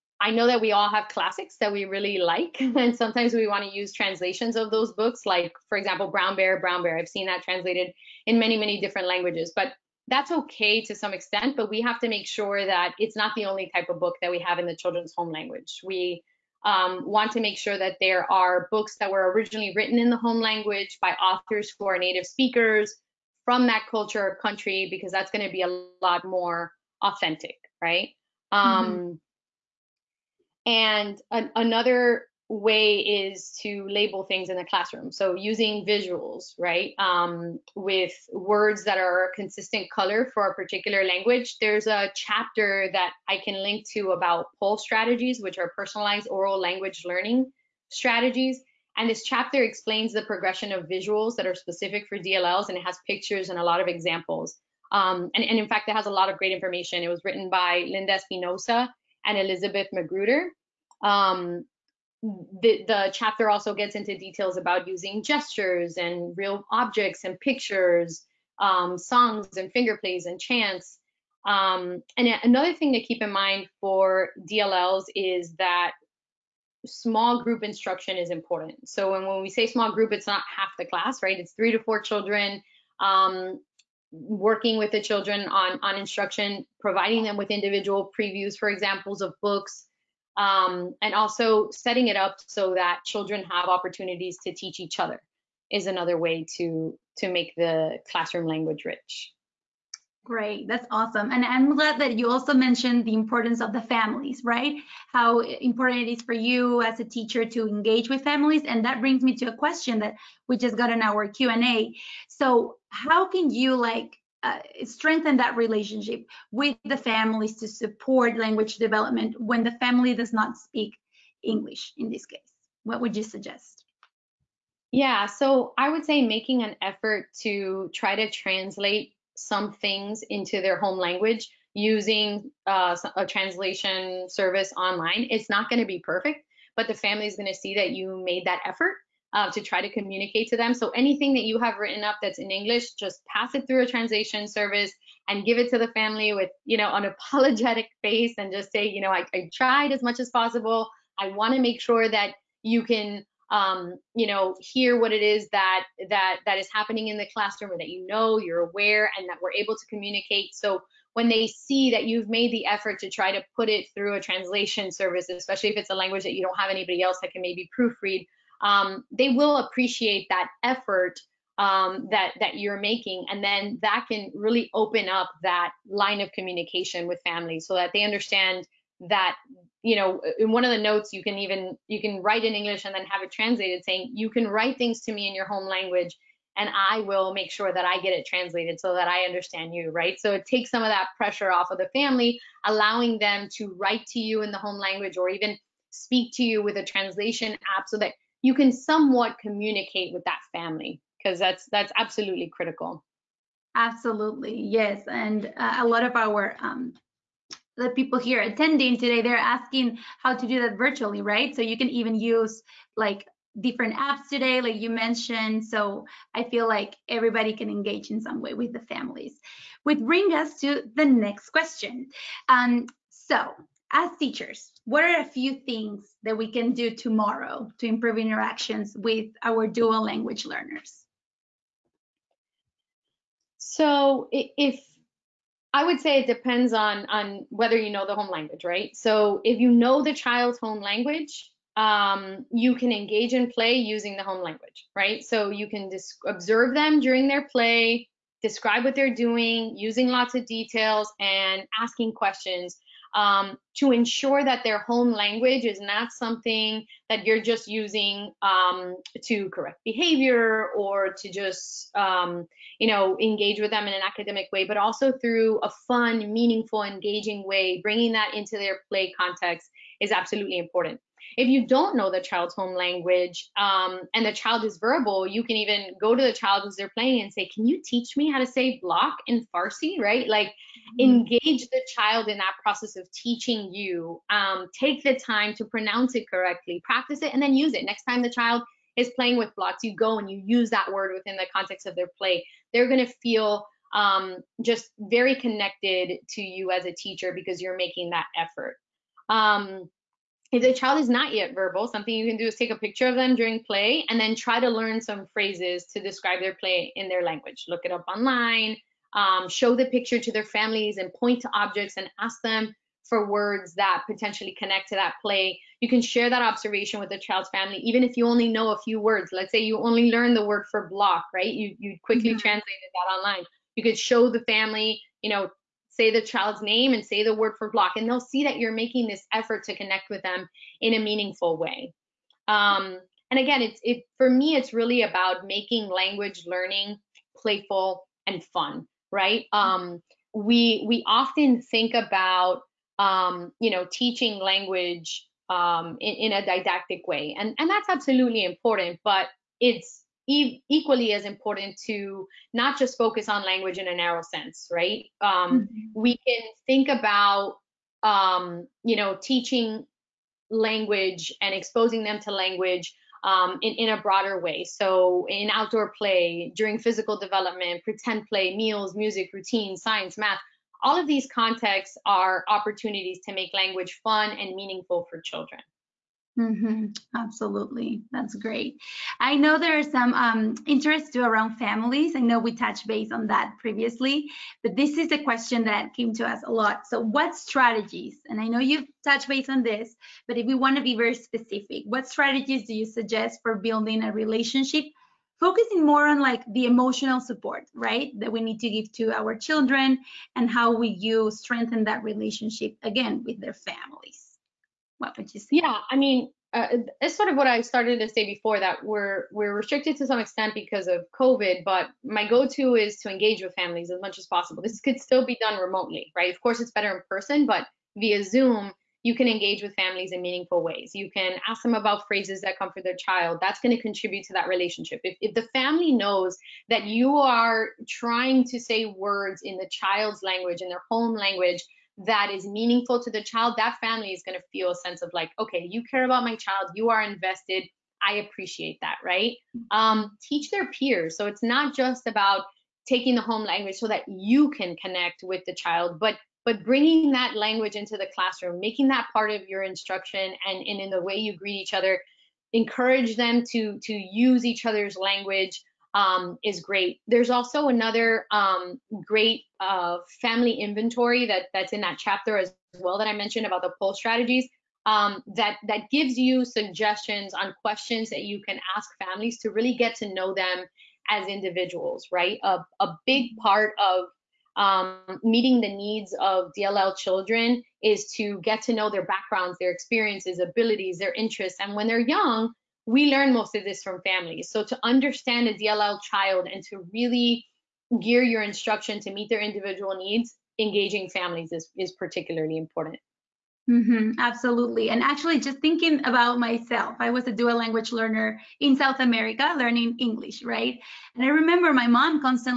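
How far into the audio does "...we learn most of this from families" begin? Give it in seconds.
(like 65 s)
482 s.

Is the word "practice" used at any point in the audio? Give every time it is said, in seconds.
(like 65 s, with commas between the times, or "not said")
286 s.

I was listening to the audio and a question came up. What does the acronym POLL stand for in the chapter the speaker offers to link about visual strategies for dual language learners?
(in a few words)
Personalized oral language learning.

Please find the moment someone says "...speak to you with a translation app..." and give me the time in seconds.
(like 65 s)
195 s.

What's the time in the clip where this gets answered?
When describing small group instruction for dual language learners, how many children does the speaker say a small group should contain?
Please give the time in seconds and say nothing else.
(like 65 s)
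81 s.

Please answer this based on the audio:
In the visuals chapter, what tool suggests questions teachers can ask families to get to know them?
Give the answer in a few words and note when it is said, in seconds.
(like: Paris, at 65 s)
Family inventory, at 460 s.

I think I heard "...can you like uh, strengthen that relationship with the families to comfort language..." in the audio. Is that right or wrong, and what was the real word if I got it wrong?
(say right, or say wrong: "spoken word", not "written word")
wrong: "support", not "comfort".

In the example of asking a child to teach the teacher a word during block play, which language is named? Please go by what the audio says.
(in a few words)
Farsi.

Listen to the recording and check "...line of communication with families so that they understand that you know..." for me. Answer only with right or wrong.
right.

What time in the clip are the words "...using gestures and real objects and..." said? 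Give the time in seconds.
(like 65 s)
64 s.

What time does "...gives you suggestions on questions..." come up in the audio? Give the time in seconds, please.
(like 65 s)
465 s.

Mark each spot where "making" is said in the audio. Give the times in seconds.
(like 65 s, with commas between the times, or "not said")
126 s, 172 s, 297 s, 328 s, 335 s, 448 s.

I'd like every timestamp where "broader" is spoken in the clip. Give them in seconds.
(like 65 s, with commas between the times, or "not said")
364 s.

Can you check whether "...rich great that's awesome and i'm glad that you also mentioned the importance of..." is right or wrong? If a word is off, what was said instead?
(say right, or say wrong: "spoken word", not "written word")
right.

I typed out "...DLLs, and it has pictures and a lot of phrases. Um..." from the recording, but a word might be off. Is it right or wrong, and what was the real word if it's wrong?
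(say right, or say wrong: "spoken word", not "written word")
wrong: "examples", not "phrases".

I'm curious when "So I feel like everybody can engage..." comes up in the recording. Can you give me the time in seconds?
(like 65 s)
215 s.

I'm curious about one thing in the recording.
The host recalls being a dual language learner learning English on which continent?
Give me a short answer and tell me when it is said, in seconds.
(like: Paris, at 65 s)
South America, at 498 s.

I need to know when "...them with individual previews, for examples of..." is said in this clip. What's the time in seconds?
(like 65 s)
87 s.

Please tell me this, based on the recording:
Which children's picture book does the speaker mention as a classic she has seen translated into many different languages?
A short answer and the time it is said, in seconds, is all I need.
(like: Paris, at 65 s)
Brown Bear, Brown Bear, at 6 s.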